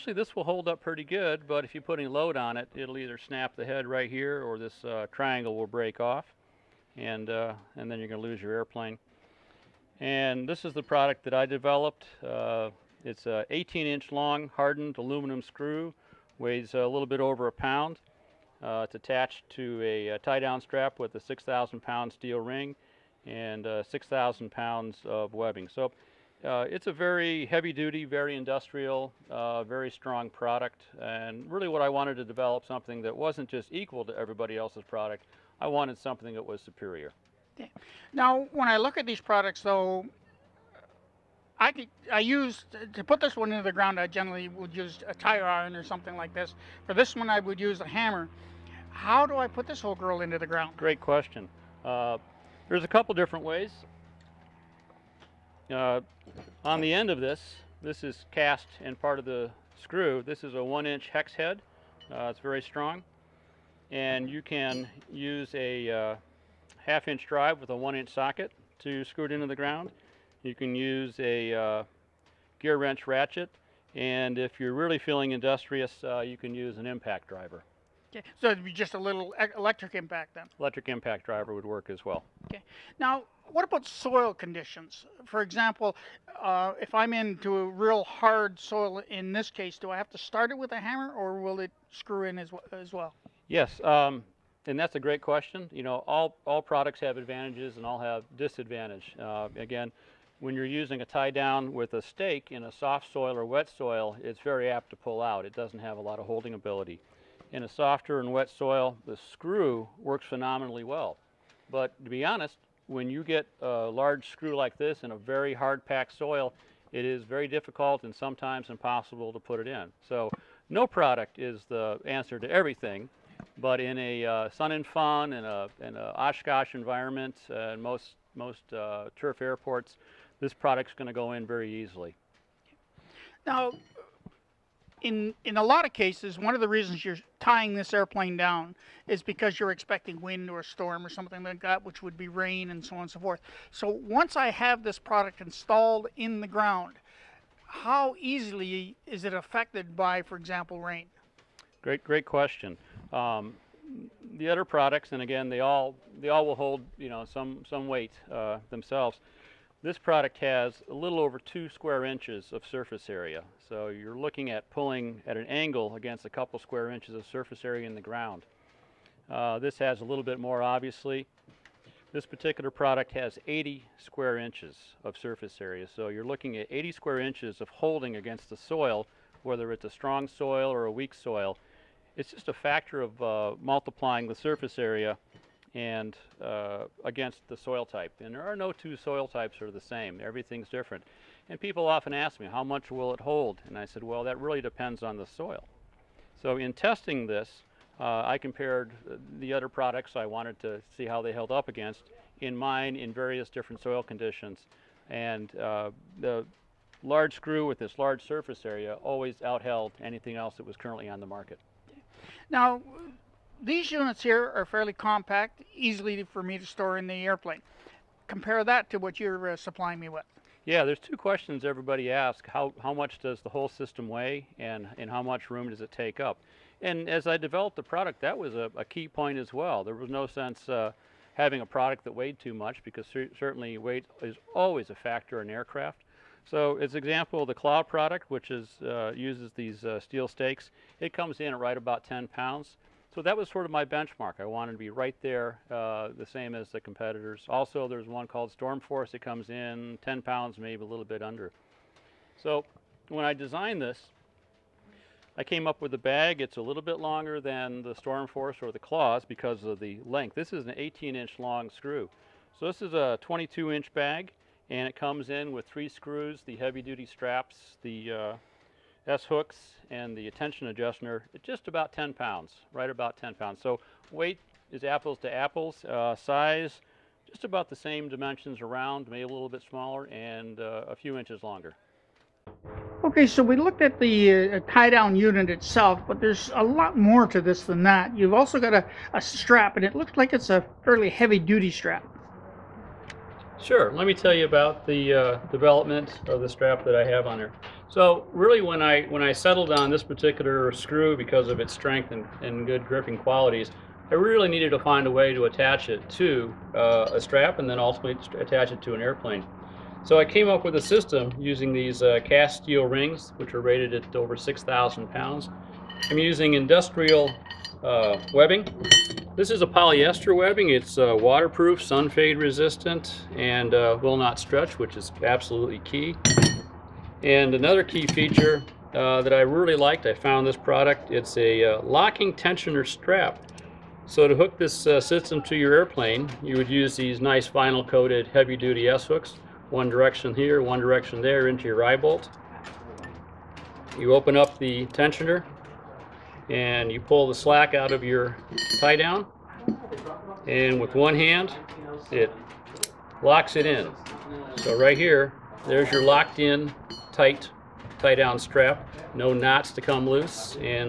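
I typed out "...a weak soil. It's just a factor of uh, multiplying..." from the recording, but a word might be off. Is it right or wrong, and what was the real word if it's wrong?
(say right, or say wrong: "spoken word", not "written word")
right.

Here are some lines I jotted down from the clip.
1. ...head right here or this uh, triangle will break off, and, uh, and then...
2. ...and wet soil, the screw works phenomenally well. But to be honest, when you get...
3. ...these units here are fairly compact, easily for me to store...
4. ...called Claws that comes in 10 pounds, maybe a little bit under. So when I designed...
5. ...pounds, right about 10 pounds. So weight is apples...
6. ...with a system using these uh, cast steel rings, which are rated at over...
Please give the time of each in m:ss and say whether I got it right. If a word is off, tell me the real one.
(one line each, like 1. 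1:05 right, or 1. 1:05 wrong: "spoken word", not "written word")
1. 0:03 right
2. 1:48 right
3. 3:33 right
4. 4:08 wrong: "Stormforce", not "Claws"
5. 4:32 right
6. 5:10 right.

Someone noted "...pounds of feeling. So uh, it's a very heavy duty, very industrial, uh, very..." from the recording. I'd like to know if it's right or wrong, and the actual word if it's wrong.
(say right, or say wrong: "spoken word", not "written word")
wrong: "webbing", not "feeling".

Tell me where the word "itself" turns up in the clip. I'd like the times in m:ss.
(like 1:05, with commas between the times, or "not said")
4:45.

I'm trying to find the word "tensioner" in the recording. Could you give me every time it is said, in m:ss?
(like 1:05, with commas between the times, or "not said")
5:32, 5:44.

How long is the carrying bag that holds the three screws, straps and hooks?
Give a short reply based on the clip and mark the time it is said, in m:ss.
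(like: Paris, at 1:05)
22 inches, at 4:23.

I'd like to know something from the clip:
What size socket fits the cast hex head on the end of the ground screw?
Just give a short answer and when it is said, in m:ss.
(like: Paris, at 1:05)
1 inch, at 1:07.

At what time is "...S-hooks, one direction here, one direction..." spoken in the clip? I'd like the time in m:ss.
5:38.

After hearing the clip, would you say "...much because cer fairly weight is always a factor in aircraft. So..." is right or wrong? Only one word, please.
wrong.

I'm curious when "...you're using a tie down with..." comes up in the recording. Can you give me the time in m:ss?
1:40.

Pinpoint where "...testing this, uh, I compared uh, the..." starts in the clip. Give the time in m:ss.
3:16.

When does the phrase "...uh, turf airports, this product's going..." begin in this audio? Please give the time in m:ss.
2:08.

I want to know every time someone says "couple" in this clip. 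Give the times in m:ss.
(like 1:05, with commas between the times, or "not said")
0:52, 2:46.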